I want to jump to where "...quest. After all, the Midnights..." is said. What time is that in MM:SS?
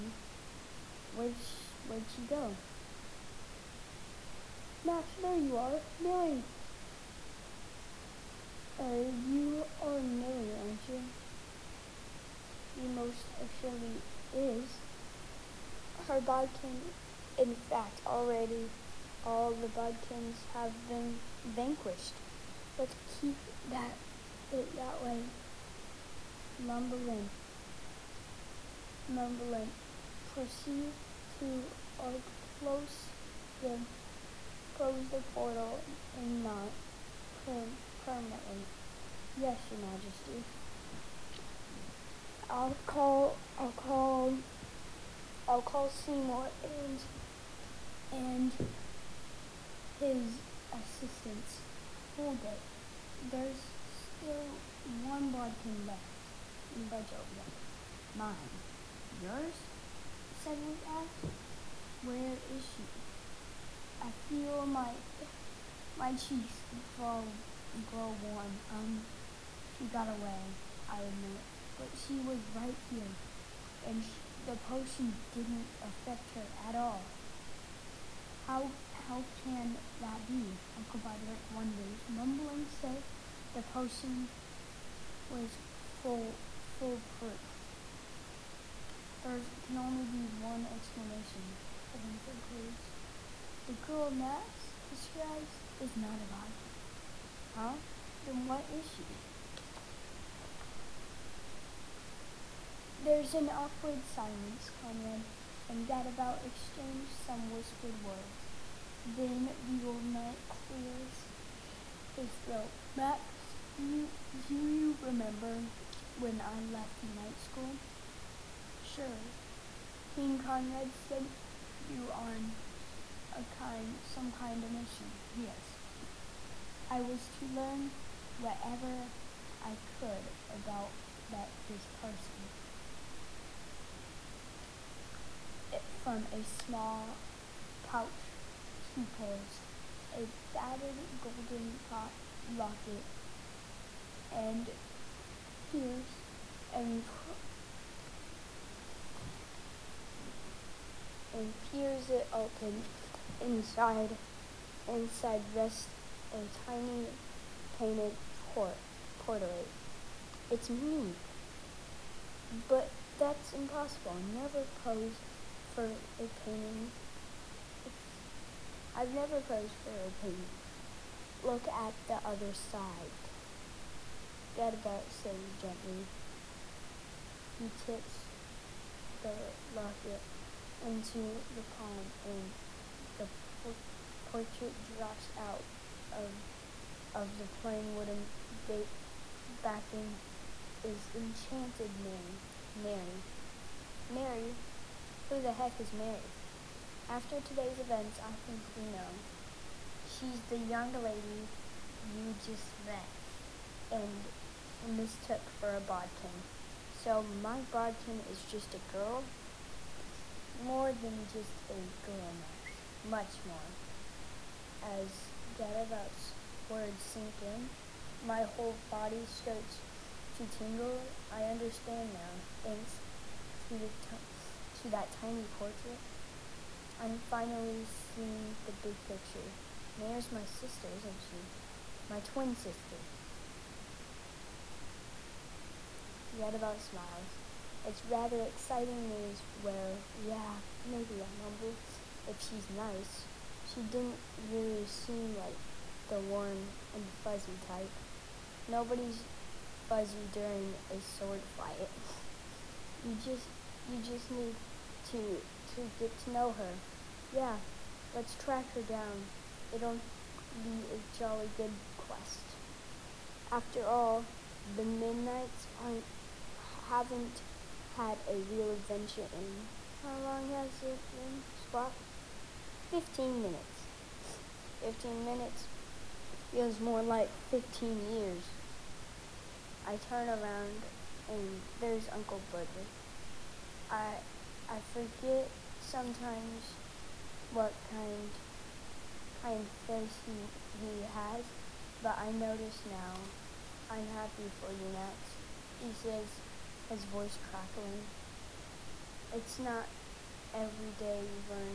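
04:21.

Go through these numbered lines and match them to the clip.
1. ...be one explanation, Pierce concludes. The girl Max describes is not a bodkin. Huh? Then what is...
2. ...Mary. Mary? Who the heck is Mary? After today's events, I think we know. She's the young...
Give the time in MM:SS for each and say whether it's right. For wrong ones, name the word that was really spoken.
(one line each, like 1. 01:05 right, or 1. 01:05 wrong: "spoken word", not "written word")
1. 01:30 wrong: "Kevin", not "Pierce"
2. 03:12 right.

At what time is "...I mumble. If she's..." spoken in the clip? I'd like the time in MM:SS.
04:01.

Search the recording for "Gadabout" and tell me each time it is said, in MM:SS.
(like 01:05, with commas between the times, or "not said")
01:45, 02:54, 03:35.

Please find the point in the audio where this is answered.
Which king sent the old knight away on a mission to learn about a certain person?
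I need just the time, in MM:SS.
02:00.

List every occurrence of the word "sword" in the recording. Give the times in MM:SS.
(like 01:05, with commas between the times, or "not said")
04:11.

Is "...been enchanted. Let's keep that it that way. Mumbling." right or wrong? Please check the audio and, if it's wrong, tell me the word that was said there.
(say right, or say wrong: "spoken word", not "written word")
wrong: "vanquished", not "enchanted".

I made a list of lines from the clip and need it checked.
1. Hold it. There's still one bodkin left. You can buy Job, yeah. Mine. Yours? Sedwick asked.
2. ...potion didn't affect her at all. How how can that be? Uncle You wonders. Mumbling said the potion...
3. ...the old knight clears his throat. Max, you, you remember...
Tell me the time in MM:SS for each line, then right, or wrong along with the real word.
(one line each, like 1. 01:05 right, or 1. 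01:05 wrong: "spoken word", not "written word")
1. 00:52 right
2. 01:14 wrong: "Budrick", not "You"
3. 01:49 right.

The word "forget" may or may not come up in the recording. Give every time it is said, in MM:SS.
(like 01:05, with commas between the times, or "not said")
04:44.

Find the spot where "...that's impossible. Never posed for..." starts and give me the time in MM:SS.
02:43.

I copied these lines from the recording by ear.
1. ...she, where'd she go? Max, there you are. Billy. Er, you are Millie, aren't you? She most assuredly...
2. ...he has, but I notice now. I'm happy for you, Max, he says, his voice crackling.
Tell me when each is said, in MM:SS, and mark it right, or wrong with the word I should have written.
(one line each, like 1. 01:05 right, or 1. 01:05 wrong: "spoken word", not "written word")
1. 00:01 right
2. 04:50 right.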